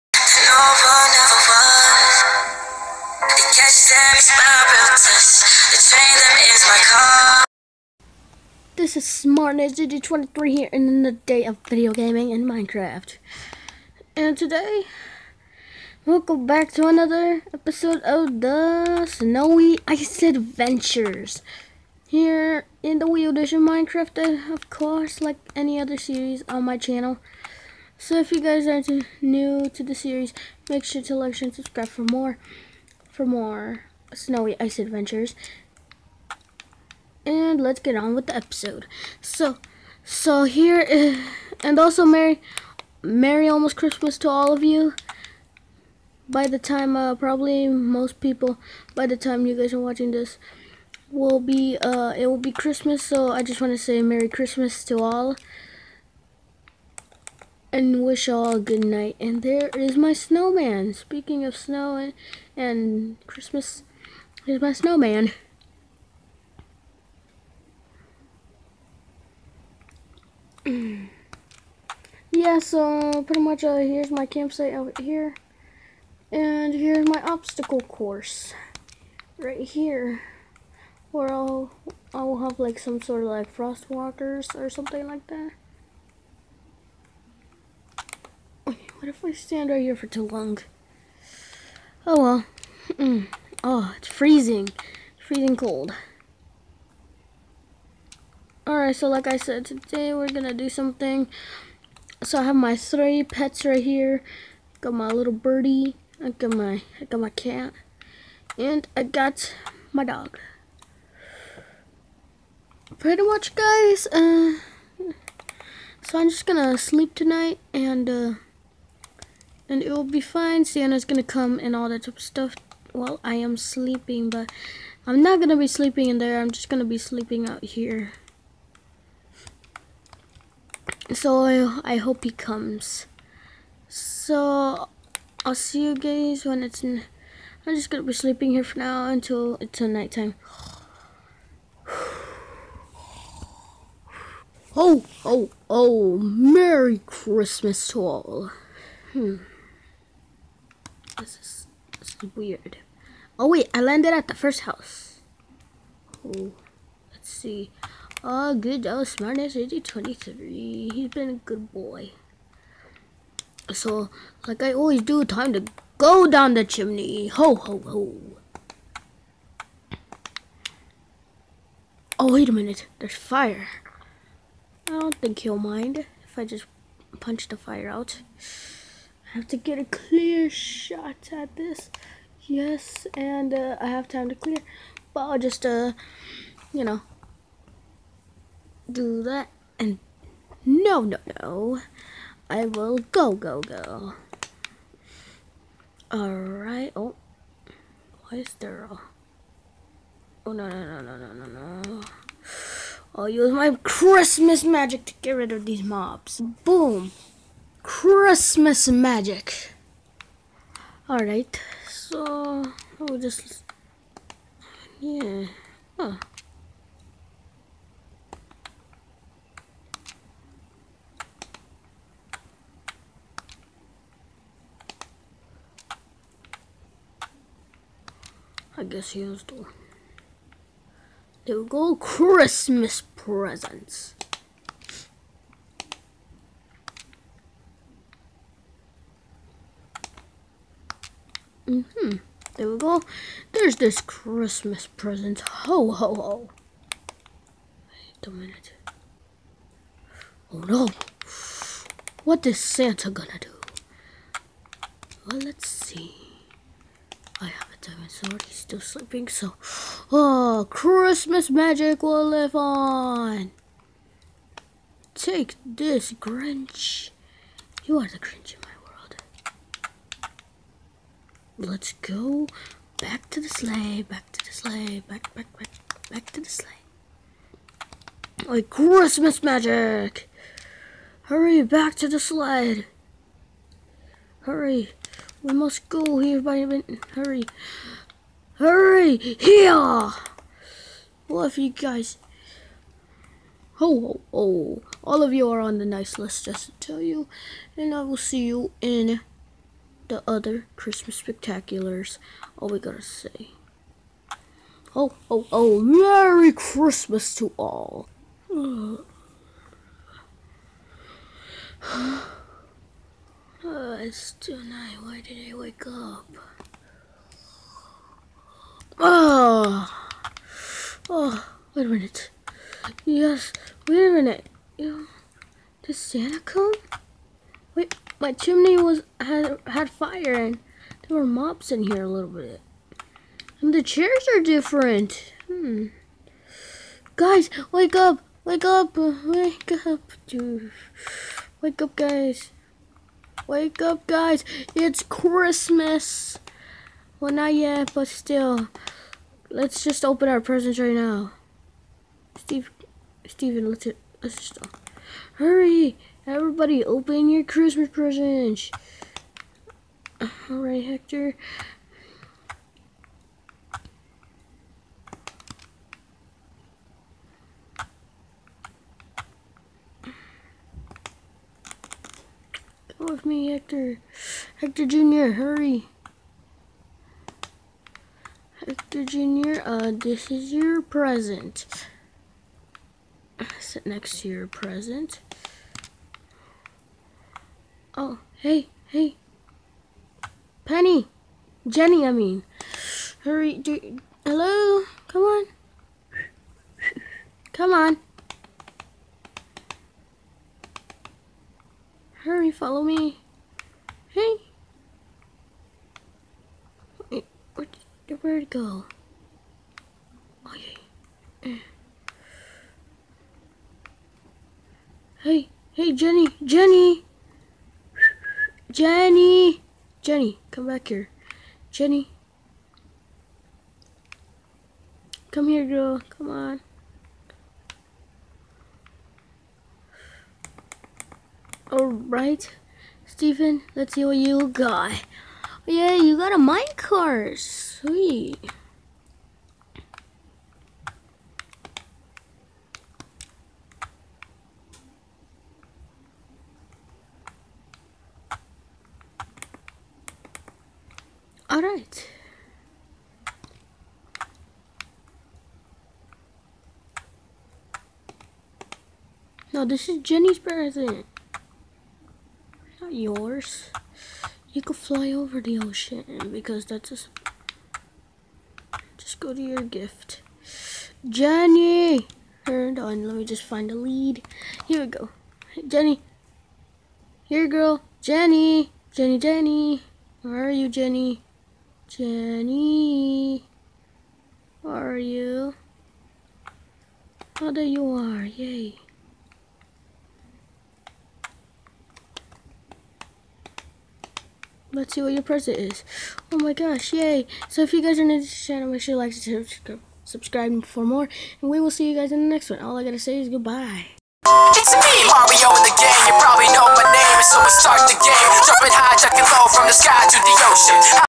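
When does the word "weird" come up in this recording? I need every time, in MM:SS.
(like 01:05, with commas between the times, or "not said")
02:32.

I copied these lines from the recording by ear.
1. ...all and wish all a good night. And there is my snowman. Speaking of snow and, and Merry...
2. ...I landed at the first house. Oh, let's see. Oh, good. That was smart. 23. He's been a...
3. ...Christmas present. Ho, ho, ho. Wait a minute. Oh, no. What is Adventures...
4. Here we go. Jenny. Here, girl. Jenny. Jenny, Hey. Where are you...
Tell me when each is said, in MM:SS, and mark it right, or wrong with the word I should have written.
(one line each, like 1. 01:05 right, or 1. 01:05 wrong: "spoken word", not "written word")
1. 00:54 wrong: "Christmas", not "Merry"
2. 02:33 right
3. 04:04 wrong: "Santa", not "Adventures"
4. 07:54 wrong: "Jenny", not "Hey".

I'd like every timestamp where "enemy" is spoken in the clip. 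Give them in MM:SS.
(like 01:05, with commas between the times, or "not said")
not said.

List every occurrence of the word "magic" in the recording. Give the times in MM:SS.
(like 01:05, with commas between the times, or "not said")
03:24, 03:28, 04:21, 04:39.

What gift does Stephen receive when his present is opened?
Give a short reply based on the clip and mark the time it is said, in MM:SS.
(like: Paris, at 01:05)
minecart, at 07:16.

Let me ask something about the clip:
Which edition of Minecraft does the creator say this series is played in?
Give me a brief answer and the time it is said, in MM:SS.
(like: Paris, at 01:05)
Wii Edition, at 00:23.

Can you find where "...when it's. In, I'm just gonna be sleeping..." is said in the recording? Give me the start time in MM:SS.
02:16.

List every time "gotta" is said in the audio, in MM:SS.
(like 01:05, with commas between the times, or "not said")
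05:02, 08:22.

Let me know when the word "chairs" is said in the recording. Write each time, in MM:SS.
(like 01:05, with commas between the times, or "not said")
05:33.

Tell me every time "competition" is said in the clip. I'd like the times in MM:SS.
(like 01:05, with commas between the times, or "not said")
not said.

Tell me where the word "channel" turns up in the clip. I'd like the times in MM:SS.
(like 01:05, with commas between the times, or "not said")
00:26, 08:18.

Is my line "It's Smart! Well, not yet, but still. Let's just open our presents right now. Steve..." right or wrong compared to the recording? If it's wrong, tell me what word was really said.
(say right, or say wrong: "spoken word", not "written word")
wrong: "Christmas", not "Smart".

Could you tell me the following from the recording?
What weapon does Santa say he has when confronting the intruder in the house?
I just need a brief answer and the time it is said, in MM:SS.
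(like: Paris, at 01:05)
diamond sword, at 04:17.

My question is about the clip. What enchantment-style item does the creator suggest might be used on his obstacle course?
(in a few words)
frost walkers.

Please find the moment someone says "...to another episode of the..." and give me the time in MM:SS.
00:16.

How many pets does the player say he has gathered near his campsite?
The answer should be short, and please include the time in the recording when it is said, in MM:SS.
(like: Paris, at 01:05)
3, at 01:42.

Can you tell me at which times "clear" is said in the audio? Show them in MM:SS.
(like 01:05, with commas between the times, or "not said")
02:59, 03:04.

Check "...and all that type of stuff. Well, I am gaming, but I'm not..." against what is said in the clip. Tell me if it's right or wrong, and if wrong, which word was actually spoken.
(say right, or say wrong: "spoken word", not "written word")
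wrong: "sleeping", not "gaming".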